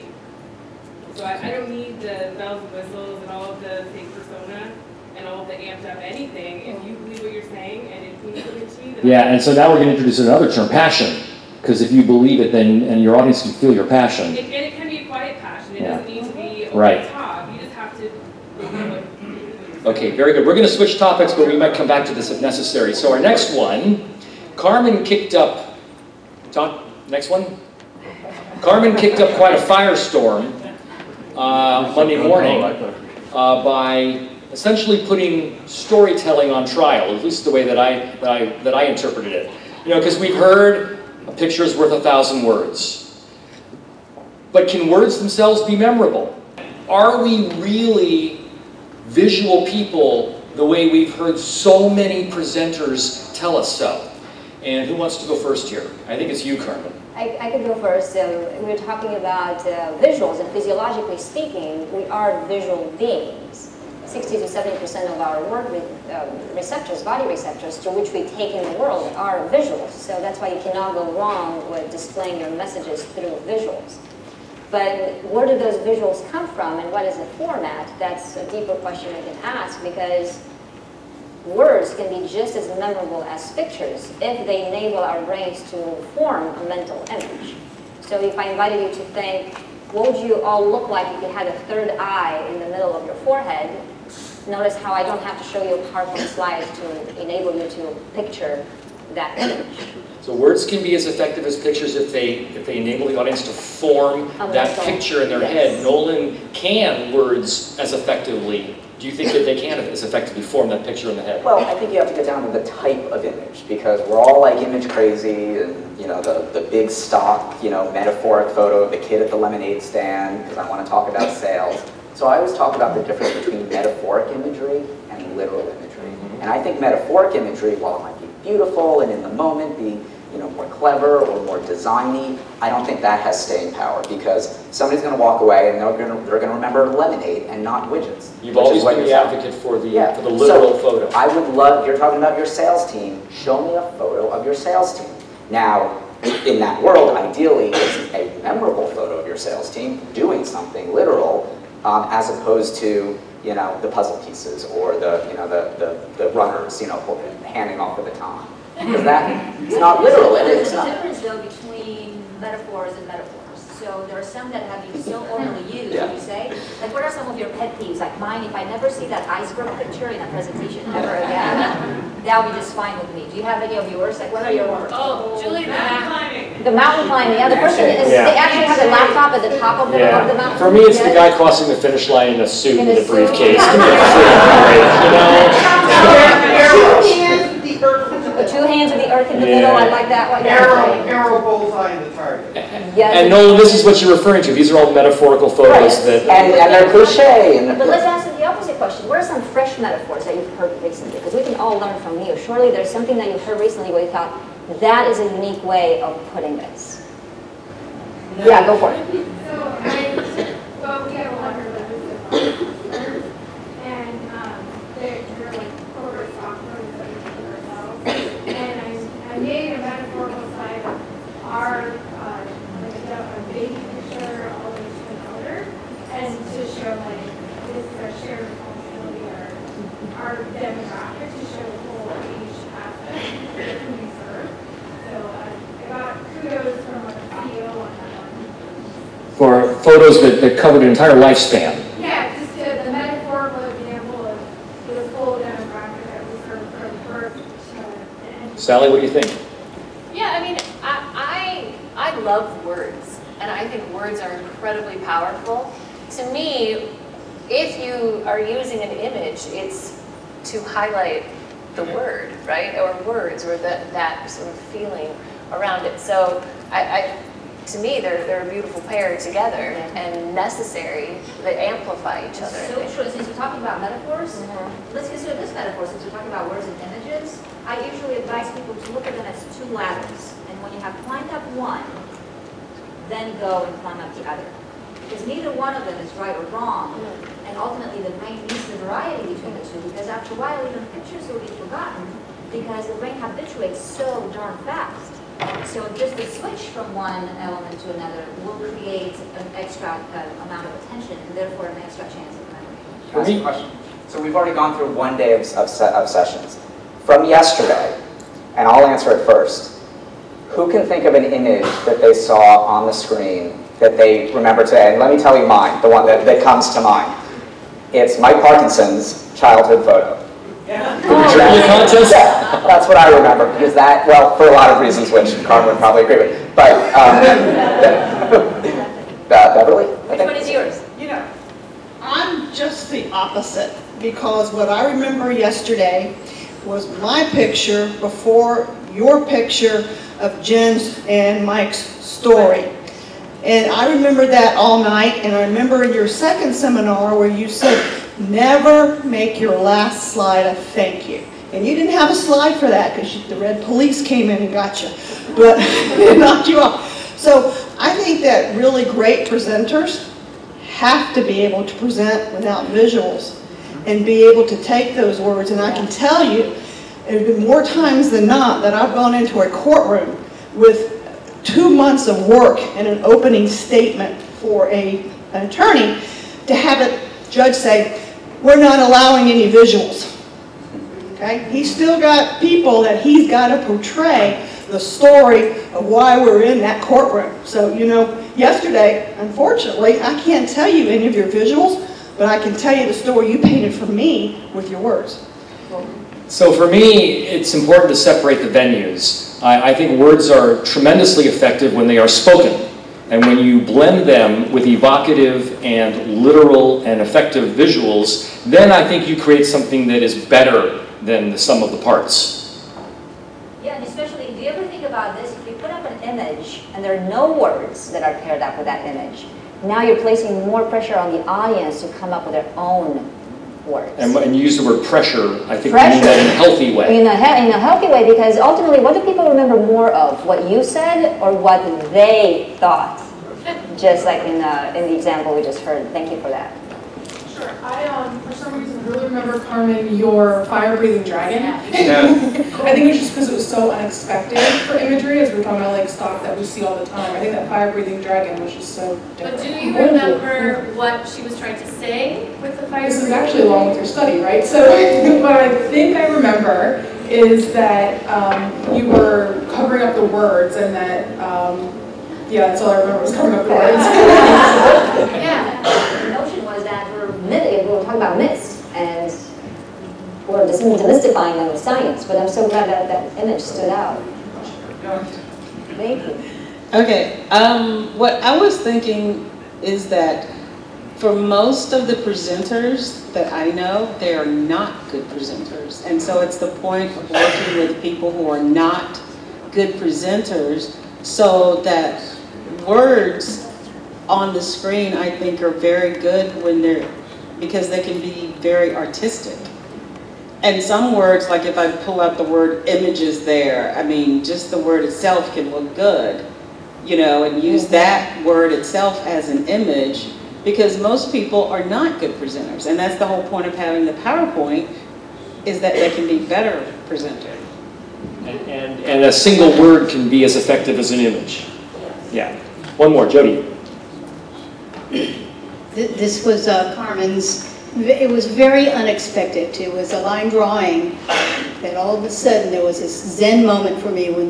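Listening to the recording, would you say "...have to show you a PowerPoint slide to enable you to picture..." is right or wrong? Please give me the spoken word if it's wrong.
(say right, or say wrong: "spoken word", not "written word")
right.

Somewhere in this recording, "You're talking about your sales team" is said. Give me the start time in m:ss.
2:21.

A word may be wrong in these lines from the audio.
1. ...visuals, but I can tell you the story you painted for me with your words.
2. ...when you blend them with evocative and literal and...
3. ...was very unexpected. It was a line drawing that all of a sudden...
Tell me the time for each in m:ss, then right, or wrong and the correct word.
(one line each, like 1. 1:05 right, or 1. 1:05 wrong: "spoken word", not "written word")
1. 6:31 right
2. 6:43 right
3. 8:48 right.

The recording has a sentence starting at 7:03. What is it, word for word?
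And, and you use the word pressure, I think pressure.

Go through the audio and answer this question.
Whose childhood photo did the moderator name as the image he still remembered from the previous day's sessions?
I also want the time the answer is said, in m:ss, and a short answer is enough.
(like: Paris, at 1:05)
Mike Parkinson, at 5:18.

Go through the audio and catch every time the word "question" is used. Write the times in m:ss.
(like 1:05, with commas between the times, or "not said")
1:18, 3:18, 5:03.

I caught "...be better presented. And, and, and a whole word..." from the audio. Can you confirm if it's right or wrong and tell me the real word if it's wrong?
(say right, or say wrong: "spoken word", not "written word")
wrong: "single", not "whole".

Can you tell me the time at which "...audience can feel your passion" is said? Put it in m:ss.
0:13.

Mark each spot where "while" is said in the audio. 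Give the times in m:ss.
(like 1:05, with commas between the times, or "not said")
2:07, 4:50.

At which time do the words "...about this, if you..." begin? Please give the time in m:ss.
6:54.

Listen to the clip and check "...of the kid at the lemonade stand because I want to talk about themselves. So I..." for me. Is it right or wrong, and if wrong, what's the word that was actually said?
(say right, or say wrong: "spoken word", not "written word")
wrong: "sales", not "themselves".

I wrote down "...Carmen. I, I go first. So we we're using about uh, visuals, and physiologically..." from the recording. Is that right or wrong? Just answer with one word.
wrong.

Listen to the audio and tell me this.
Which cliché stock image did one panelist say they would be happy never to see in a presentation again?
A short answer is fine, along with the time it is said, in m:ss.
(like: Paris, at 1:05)
iceberg, at 2:49.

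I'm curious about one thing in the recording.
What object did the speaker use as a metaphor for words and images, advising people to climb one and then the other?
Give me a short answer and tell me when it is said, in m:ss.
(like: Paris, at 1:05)
ladders, at 4:39.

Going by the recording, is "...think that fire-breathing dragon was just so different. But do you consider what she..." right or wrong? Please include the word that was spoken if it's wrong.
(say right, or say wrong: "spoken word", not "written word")
wrong: "remember", not "consider".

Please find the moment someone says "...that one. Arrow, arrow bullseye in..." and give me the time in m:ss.
3:10.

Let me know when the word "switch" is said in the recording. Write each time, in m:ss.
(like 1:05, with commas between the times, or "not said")
0:20, 4:56.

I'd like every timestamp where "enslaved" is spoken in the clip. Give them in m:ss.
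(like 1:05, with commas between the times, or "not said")
not said.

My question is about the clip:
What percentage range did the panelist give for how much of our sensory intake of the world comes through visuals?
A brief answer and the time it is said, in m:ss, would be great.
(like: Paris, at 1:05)
60 to 70 percent, at 1:04.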